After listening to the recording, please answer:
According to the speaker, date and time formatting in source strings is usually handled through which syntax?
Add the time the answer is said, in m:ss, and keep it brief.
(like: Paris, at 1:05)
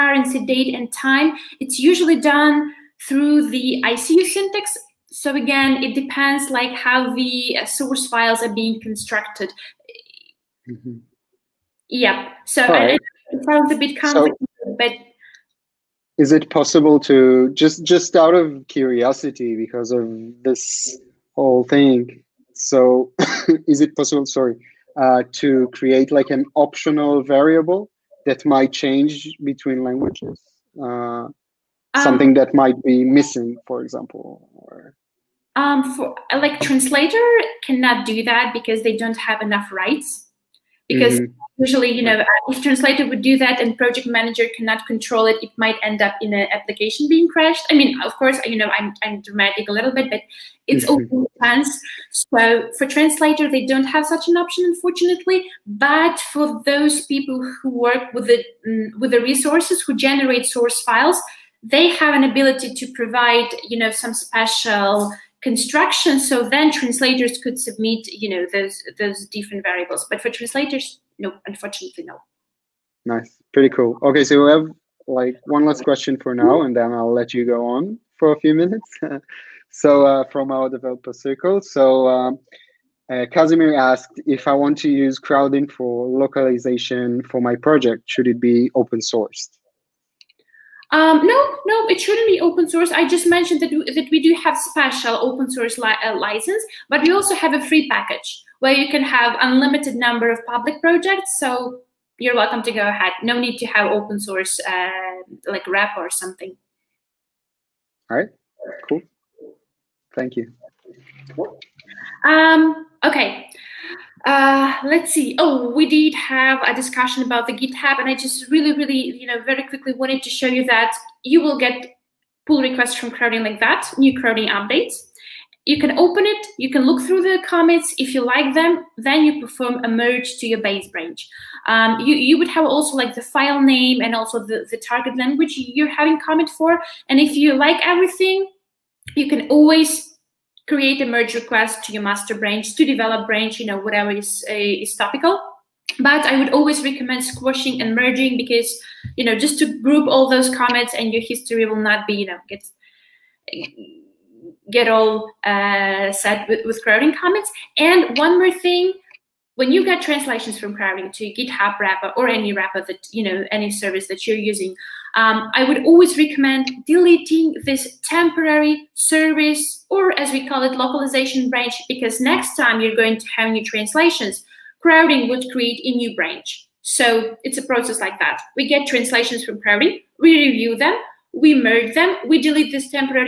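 ICU syntax, at 0:03.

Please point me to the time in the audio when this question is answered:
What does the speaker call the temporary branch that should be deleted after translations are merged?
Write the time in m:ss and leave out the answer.
2:50.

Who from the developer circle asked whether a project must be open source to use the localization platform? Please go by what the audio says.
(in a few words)
Casimir.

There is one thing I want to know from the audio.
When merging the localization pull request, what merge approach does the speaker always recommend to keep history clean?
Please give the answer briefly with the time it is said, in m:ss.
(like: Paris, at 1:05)
squashing and merging, at 2:27.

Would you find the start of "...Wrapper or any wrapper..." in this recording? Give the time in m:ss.
2:41.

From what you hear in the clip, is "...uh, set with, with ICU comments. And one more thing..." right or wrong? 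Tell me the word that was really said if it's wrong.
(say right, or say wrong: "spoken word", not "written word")
wrong: "Crowdin", not "ICU".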